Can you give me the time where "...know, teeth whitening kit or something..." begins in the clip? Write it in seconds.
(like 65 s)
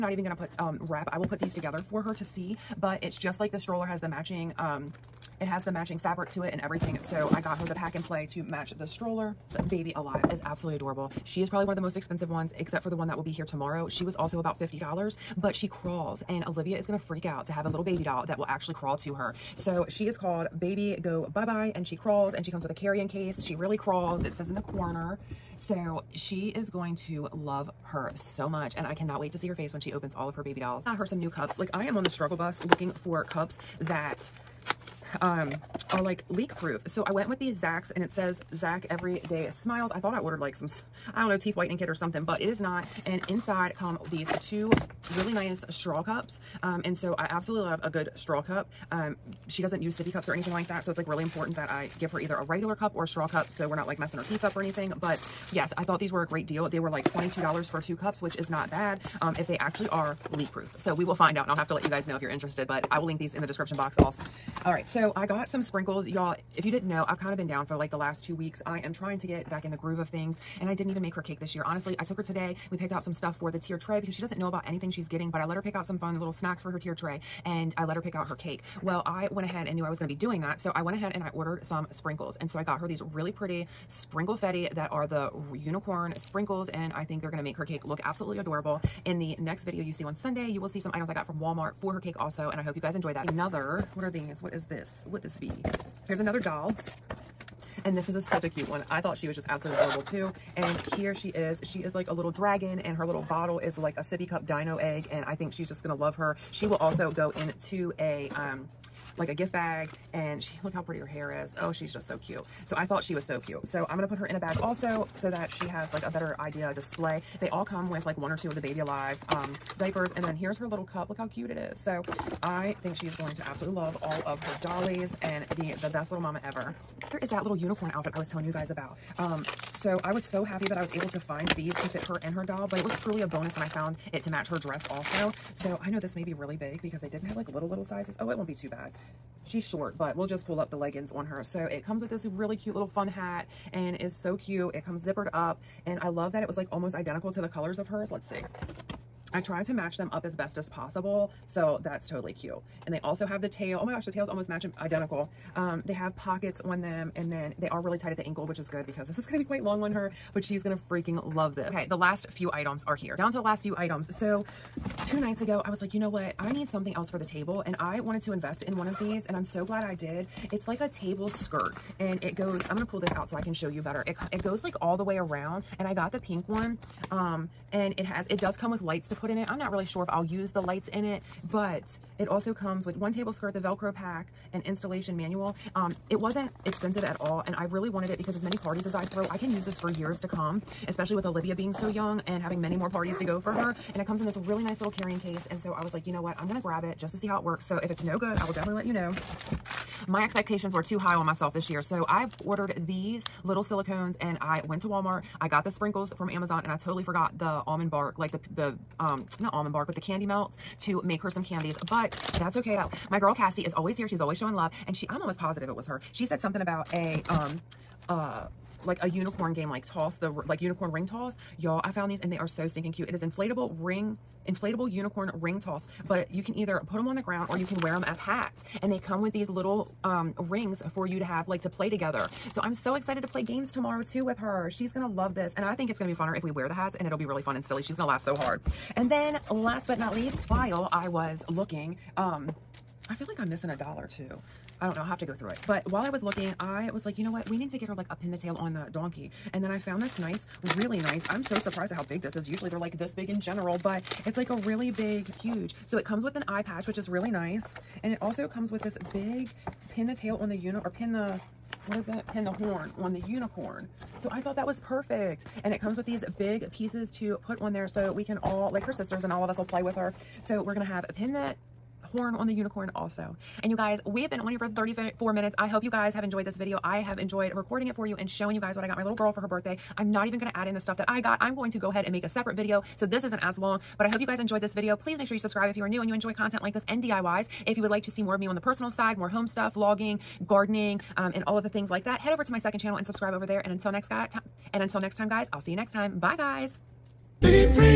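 41 s.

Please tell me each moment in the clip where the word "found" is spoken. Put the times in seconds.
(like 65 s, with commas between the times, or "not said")
133 s, 221 s, 249 s.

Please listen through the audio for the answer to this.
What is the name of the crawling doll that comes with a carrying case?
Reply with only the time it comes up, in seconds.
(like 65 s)
20 s.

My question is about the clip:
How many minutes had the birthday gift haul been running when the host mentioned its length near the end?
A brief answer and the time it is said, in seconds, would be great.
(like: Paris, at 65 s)
34, at 274 s.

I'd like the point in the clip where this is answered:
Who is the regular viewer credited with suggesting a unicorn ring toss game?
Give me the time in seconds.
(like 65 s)
213 s.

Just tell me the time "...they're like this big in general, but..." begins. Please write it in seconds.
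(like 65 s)
252 s.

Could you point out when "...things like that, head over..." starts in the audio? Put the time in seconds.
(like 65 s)
291 s.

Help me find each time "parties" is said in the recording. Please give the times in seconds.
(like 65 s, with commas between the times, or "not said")
188 s, 192 s.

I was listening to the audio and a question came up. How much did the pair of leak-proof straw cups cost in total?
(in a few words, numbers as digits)
$22.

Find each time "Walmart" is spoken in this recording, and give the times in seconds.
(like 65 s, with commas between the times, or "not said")
91 s, 204 s.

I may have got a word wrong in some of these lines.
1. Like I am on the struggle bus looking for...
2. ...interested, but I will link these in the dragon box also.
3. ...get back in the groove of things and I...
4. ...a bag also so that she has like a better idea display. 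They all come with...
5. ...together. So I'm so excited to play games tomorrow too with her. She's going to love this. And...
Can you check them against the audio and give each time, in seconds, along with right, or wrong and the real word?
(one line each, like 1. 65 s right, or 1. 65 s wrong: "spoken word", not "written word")
1. 31 s right
2. 62 s wrong: "description", not "dragon"
3. 69 s right
4. 114 s right
5. 231 s right.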